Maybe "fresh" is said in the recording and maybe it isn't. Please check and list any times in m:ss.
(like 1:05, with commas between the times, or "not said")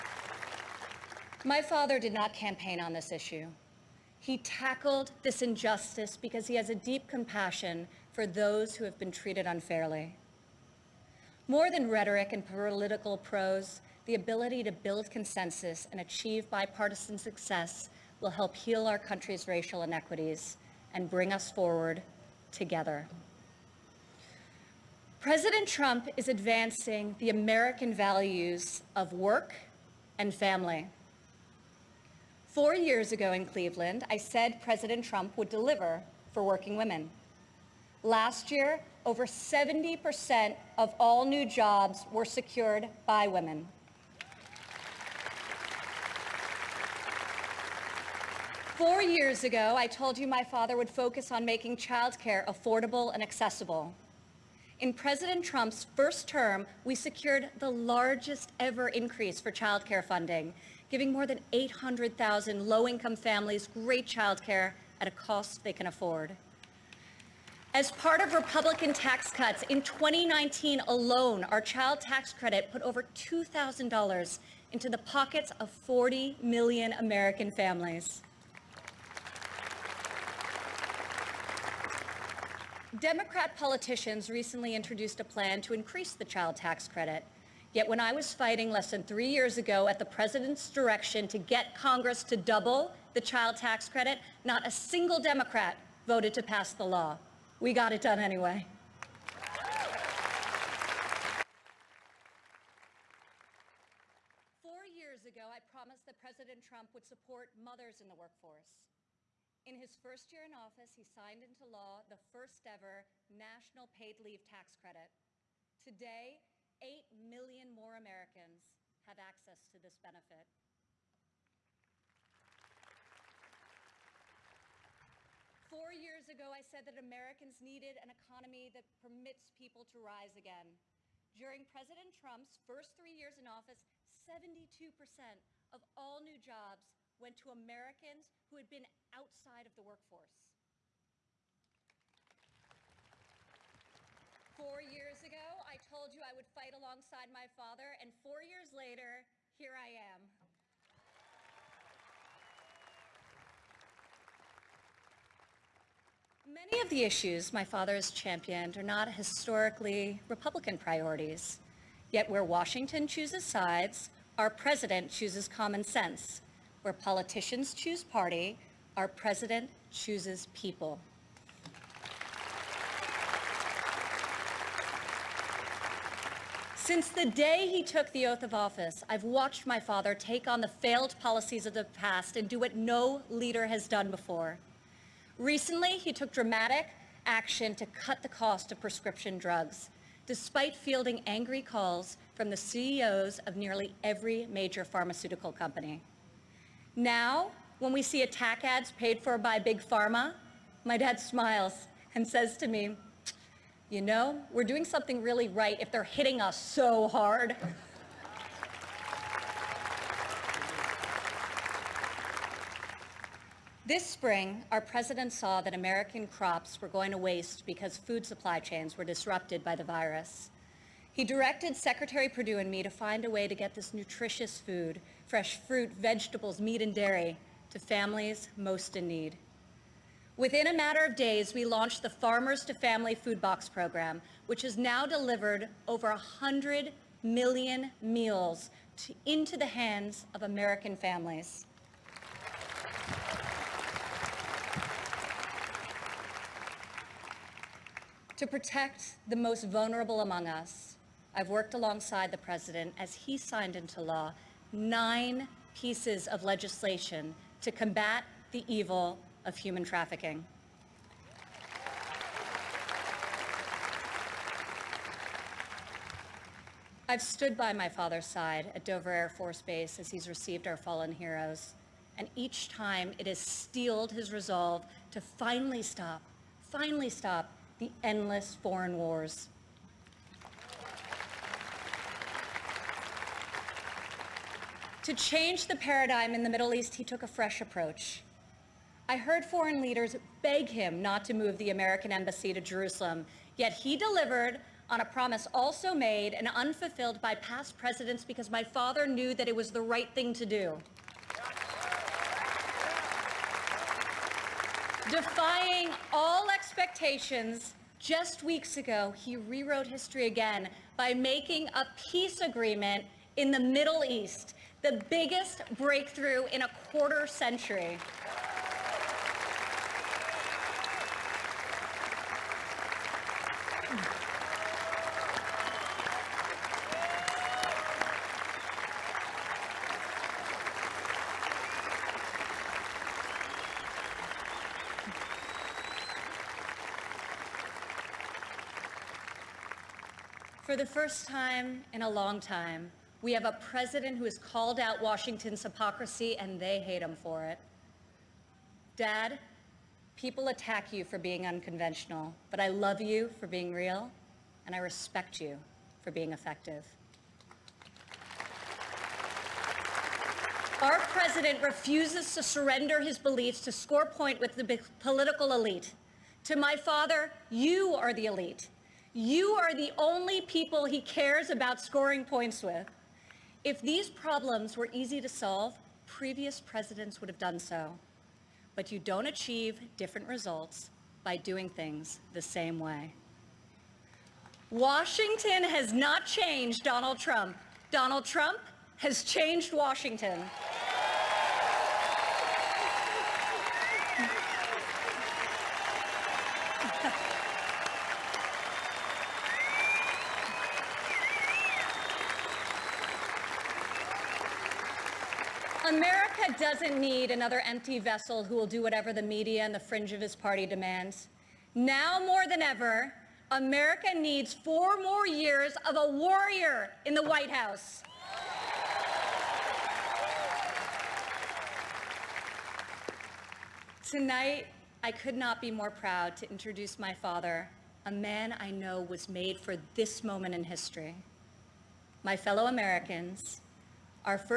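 3:45, 4:47.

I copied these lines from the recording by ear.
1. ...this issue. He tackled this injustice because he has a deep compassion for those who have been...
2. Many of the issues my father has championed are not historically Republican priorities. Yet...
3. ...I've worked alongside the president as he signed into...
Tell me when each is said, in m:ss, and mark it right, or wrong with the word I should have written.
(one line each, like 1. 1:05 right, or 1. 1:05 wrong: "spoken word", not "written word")
1. 0:02 right
2. 2:36 right
3. 4:11 right.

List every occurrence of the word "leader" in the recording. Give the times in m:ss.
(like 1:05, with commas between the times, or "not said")
3:03, 4:49.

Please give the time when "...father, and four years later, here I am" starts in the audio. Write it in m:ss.
2:27.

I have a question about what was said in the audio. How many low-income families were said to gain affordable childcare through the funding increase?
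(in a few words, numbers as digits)
800,000.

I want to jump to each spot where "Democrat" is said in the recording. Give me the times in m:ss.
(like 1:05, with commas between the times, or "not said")
1:22, 1:35.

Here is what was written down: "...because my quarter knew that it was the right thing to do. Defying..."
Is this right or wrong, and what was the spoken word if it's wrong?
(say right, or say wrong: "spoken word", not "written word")
wrong: "father", not "quarter".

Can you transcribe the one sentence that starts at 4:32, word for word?
And each time it has steeled his resolve to finally stop, finally stop the endless foreign wars.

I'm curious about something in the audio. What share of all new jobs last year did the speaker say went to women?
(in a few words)
over 70%.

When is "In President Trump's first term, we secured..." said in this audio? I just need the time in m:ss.
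0:54.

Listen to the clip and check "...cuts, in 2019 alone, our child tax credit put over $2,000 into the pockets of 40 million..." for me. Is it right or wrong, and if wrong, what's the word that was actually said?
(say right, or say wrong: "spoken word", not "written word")
right.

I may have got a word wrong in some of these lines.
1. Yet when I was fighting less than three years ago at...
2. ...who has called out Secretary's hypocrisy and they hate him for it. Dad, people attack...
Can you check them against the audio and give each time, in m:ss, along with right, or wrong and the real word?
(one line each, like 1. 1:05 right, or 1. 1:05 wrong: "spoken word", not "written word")
1. 1:27 right
2. 5:44 wrong: "Washington", not "Secretary".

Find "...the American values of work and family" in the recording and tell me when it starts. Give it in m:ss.
0:27.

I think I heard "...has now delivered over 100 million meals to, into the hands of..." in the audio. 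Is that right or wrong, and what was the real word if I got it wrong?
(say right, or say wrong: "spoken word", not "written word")
right.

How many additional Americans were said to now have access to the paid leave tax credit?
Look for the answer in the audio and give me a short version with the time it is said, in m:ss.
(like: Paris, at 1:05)
8 million, at 1:56.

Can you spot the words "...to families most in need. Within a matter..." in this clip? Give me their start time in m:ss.
3:47.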